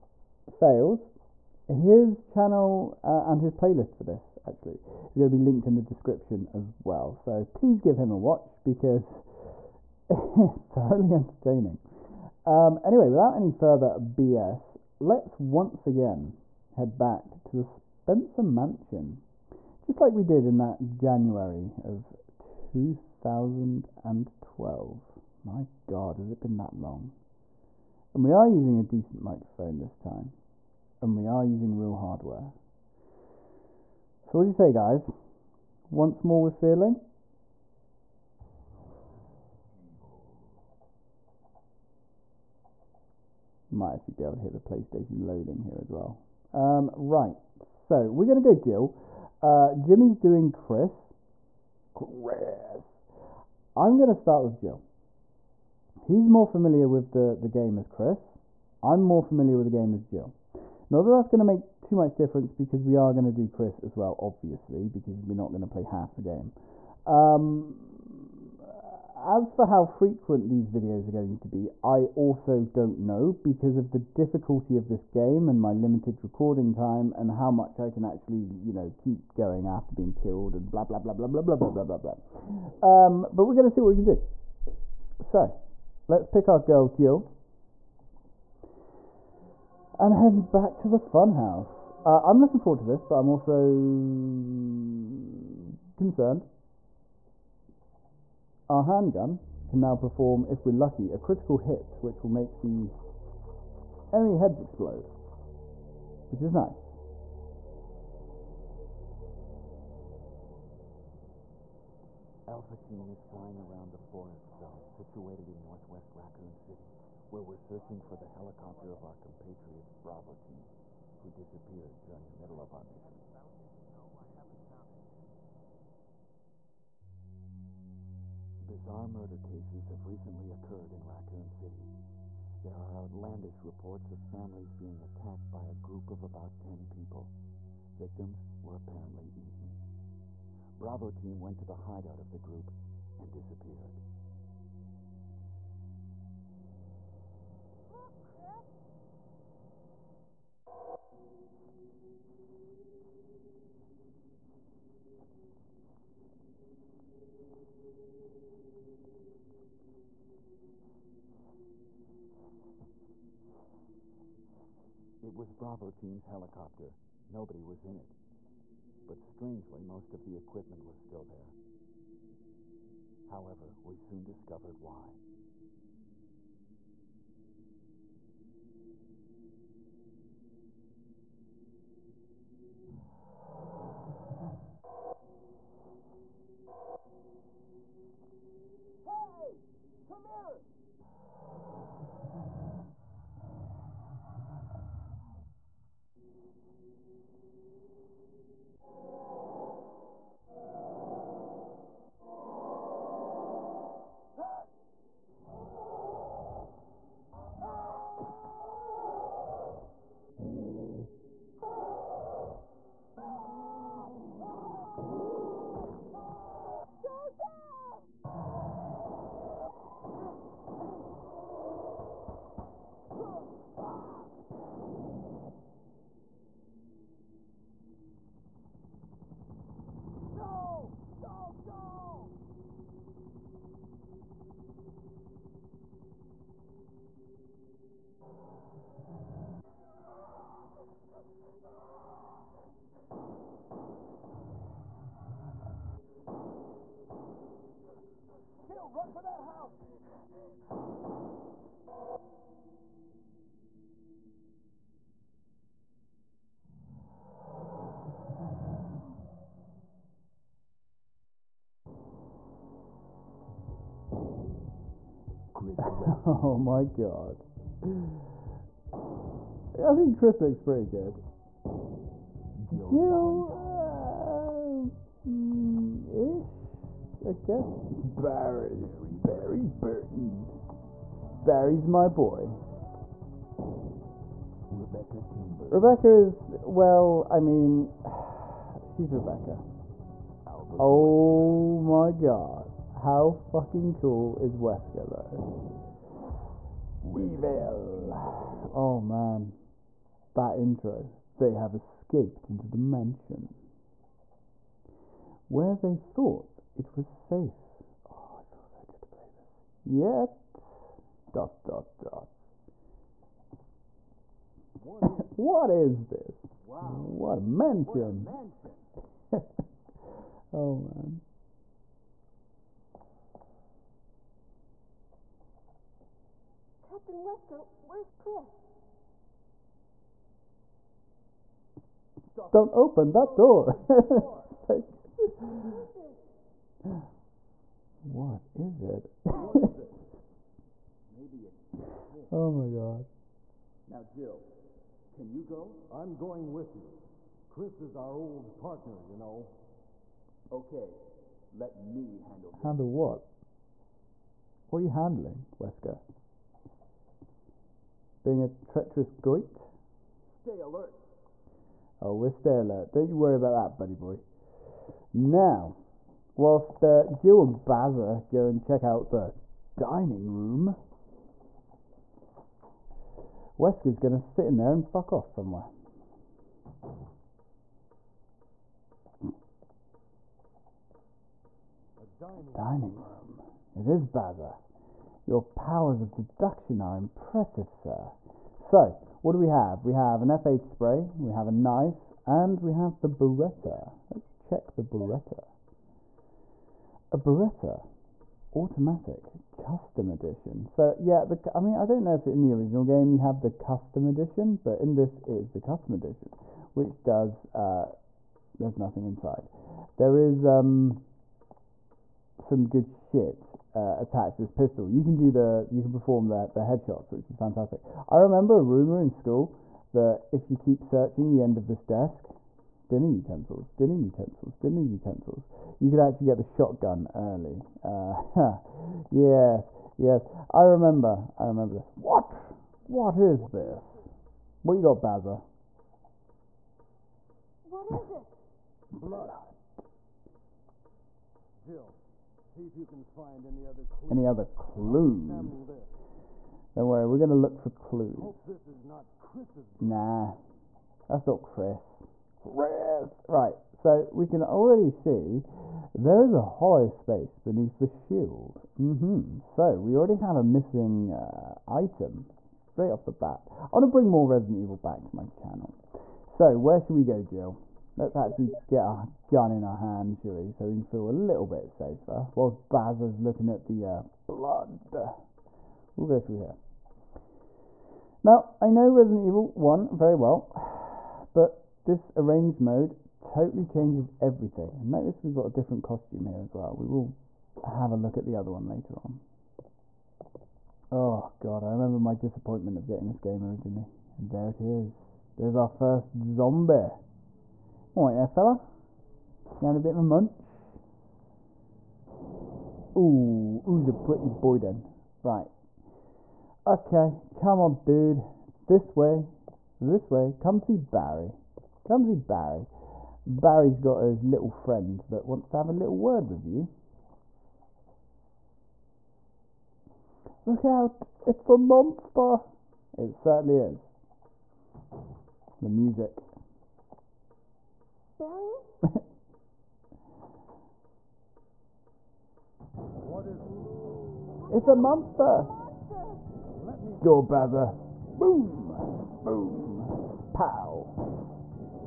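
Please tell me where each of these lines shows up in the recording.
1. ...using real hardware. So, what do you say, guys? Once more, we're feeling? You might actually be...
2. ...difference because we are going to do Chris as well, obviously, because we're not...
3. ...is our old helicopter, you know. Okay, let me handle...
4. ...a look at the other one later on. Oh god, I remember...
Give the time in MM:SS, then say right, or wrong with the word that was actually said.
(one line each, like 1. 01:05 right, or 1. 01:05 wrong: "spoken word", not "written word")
1. 00:31 right
2. 01:02 right
3. 05:47 wrong: "partner", not "helicopter"
4. 08:07 right.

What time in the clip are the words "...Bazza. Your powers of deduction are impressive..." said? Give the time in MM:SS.
06:24.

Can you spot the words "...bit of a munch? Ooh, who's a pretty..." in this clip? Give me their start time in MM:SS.
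08:19.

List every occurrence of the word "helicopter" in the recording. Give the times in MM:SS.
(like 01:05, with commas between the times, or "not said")
01:58, 02:46.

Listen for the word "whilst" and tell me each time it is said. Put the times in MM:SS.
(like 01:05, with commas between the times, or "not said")
06:06, 07:52.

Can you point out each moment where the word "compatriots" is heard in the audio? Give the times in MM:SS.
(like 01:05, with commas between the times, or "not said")
01:59.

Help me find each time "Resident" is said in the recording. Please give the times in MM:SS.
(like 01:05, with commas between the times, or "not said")
07:44, 07:58.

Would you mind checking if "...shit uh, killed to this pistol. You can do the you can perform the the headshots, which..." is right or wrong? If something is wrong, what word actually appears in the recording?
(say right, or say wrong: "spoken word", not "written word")
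wrong: "attached", not "killed".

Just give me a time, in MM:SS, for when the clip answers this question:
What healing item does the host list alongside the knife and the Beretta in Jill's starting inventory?
06:30.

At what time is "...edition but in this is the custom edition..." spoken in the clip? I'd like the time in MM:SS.
06:44.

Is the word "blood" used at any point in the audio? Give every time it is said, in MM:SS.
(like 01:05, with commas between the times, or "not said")
07:18, 07:54.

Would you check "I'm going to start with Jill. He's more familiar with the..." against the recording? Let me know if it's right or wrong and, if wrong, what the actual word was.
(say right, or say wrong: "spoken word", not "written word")
right.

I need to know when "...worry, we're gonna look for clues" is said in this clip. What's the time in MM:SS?
07:26.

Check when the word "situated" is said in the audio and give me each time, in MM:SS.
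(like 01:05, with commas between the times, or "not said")
01:54.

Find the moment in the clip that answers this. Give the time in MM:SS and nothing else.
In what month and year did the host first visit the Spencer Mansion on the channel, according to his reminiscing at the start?
00:20.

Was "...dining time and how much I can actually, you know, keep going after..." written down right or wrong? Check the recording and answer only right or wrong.
wrong.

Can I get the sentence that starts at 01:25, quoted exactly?
So, let's pick our girl, Jill.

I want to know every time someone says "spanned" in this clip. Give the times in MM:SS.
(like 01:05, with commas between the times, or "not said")
not said.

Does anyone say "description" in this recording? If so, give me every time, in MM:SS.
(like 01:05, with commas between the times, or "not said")
00:05.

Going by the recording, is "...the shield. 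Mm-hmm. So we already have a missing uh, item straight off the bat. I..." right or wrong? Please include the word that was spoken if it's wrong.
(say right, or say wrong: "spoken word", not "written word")
right.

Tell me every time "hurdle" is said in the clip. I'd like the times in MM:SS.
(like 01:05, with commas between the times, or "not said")
not said.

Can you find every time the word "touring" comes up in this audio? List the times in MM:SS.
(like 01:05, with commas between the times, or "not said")
not said.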